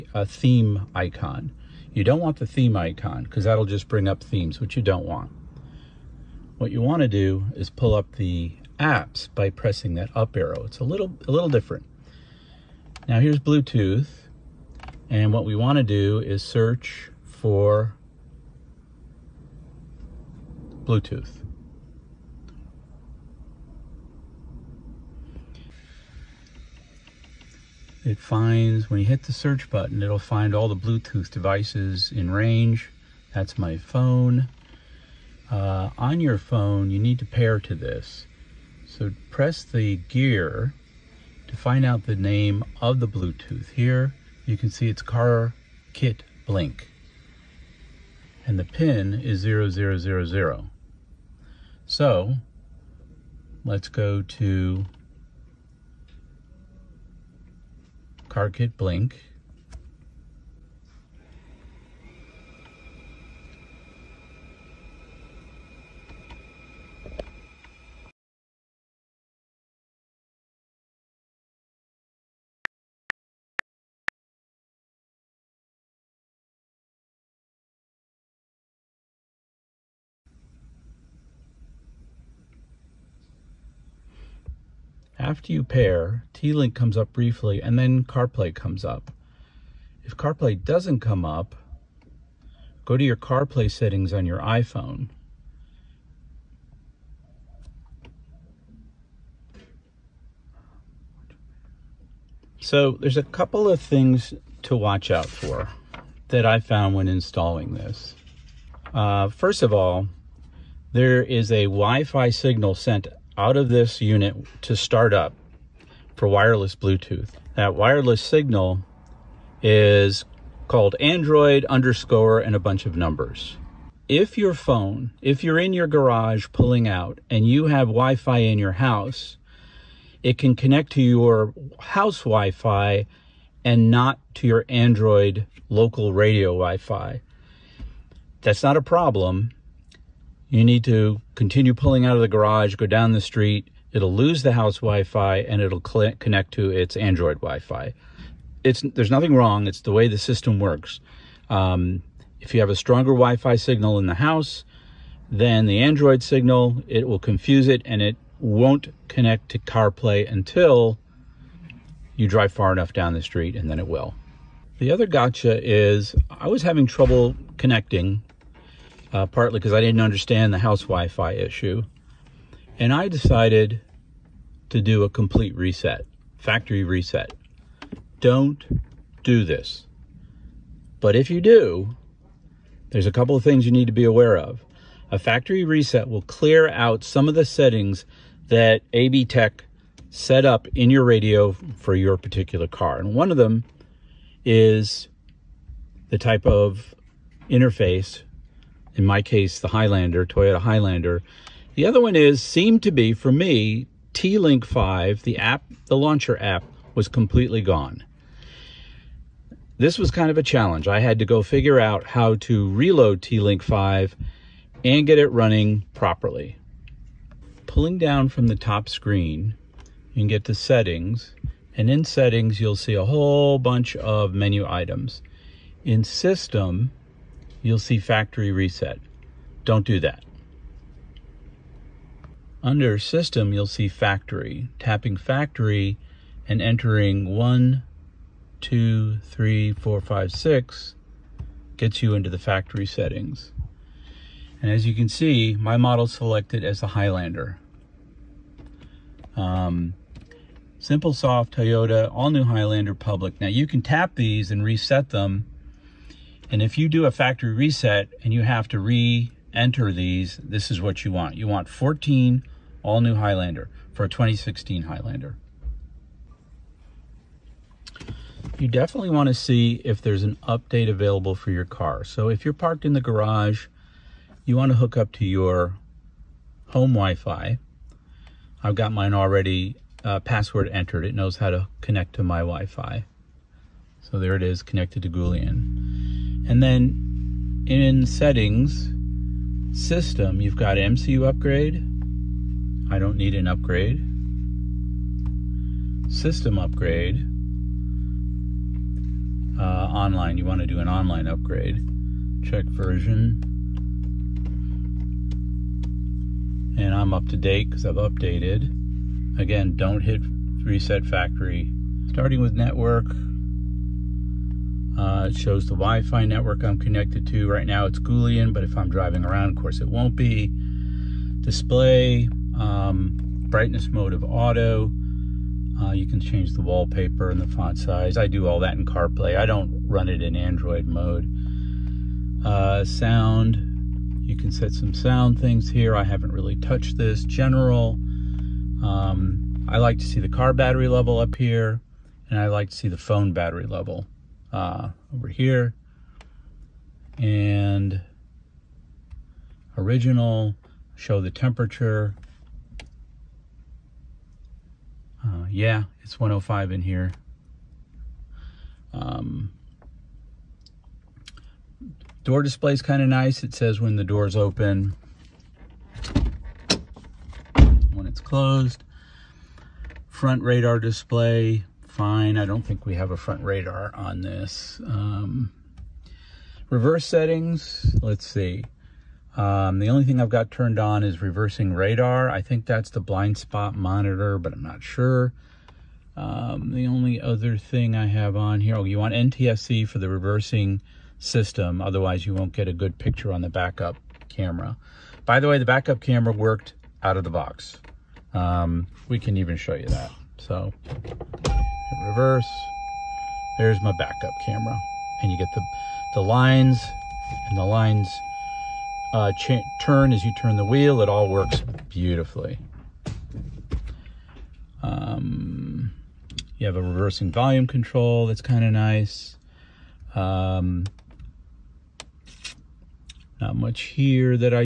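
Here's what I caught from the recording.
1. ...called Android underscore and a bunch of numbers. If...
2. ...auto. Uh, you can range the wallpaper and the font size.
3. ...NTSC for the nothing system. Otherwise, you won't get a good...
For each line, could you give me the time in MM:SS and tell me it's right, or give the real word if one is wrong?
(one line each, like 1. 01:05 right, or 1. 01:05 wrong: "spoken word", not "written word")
1. 02:00 right
2. 05:24 wrong: "change", not "range"
3. 06:29 wrong: "reversing", not "nothing".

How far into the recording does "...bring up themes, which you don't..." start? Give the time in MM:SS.
00:03.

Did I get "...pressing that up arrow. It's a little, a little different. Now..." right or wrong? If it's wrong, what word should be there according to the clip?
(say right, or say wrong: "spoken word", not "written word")
right.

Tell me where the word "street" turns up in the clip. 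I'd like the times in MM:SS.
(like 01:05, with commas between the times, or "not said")
02:23, 02:43.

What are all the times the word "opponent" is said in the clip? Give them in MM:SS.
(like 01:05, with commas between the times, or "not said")
not said.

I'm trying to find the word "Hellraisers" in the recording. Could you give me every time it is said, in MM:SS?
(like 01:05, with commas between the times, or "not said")
not said.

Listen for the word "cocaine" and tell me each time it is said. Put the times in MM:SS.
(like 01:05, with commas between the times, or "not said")
not said.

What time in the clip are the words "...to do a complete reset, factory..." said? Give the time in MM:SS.
02:54.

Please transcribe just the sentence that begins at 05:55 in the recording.
Uh, yeah, it's 105 in here.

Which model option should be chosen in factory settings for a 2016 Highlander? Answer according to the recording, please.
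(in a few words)
14 all new Highlander.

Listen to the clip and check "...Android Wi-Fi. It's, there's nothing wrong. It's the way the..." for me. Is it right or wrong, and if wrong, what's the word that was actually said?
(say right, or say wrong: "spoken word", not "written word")
right.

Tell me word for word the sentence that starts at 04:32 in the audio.
So if you're parked in the garage, you want to hook up to your home Wi-Fi.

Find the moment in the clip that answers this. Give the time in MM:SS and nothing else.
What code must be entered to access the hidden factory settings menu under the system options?
03:57.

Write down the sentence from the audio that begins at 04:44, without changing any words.
So there it is connected to Goulian.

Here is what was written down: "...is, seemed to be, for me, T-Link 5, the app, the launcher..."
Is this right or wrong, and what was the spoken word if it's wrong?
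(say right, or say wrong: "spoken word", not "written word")
right.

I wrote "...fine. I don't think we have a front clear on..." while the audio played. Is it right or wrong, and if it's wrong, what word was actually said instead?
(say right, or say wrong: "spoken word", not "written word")
wrong: "radar", not "clear".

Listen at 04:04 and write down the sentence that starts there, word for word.
And as you can see, my model selected as the Highlander.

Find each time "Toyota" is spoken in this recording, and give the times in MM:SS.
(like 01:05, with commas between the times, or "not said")
03:20, 04:11.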